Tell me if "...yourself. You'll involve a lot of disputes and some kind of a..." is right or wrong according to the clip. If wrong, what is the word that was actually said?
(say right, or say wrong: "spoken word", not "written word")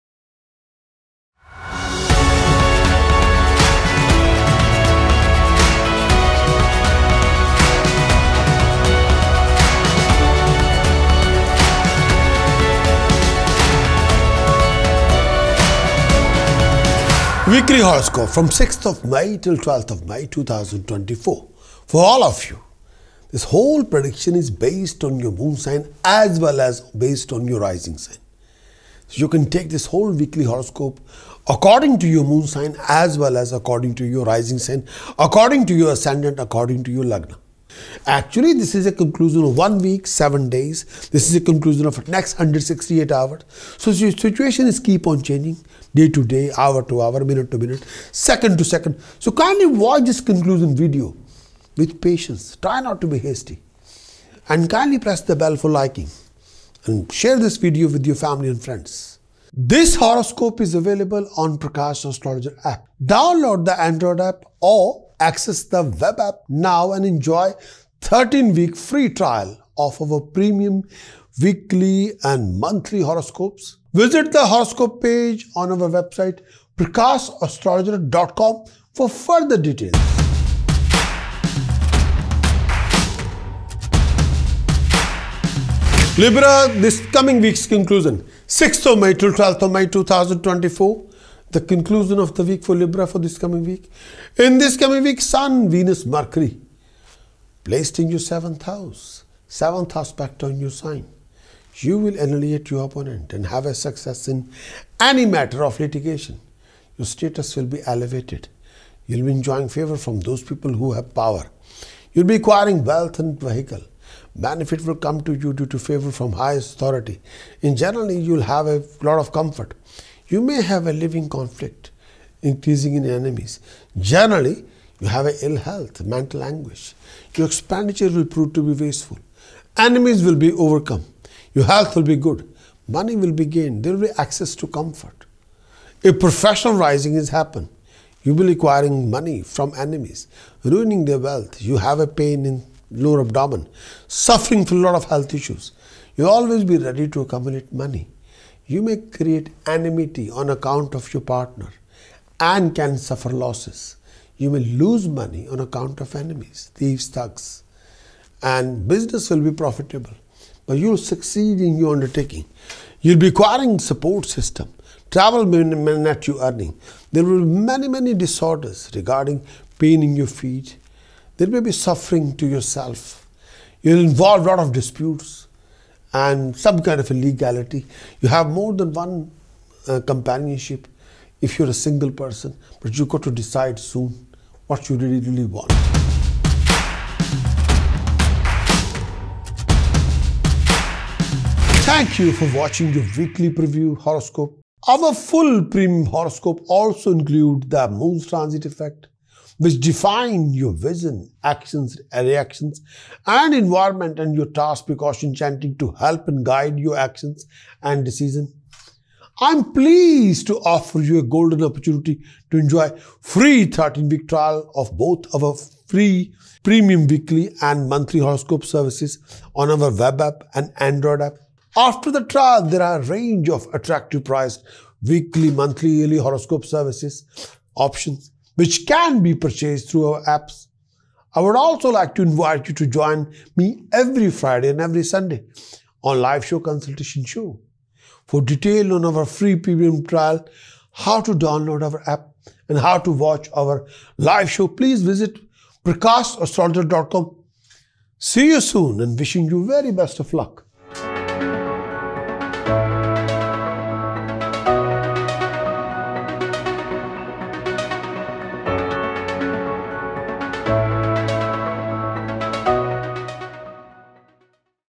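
right.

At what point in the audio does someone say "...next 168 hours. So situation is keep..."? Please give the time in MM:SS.
00:42.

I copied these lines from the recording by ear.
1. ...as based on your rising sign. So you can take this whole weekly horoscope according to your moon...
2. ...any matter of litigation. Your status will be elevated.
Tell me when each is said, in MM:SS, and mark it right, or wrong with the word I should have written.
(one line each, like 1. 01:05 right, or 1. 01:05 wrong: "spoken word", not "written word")
1. 00:26 right
2. 01:44 right.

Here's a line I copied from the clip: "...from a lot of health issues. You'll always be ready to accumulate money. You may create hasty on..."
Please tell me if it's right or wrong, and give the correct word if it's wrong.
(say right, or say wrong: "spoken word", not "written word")
wrong: "enmity", not "hasty".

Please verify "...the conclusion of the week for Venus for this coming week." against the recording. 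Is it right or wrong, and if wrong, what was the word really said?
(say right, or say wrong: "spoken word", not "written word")
wrong: "Libra", not "Venus".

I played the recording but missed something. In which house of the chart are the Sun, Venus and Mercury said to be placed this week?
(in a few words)
Seventh house.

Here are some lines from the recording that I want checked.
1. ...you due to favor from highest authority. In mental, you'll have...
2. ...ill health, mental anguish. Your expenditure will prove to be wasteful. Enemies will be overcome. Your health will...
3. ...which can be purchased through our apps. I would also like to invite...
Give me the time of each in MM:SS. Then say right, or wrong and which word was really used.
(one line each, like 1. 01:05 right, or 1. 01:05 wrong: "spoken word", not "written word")
1. 01:55 wrong: "general", not "mental"
2. 02:05 right
3. 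03:48 right.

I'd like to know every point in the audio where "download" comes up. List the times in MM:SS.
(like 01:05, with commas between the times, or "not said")
01:03, 04:01.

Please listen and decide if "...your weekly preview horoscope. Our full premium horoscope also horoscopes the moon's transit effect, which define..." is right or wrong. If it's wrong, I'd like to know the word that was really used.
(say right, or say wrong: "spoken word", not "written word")
wrong: "includes", not "horoscopes".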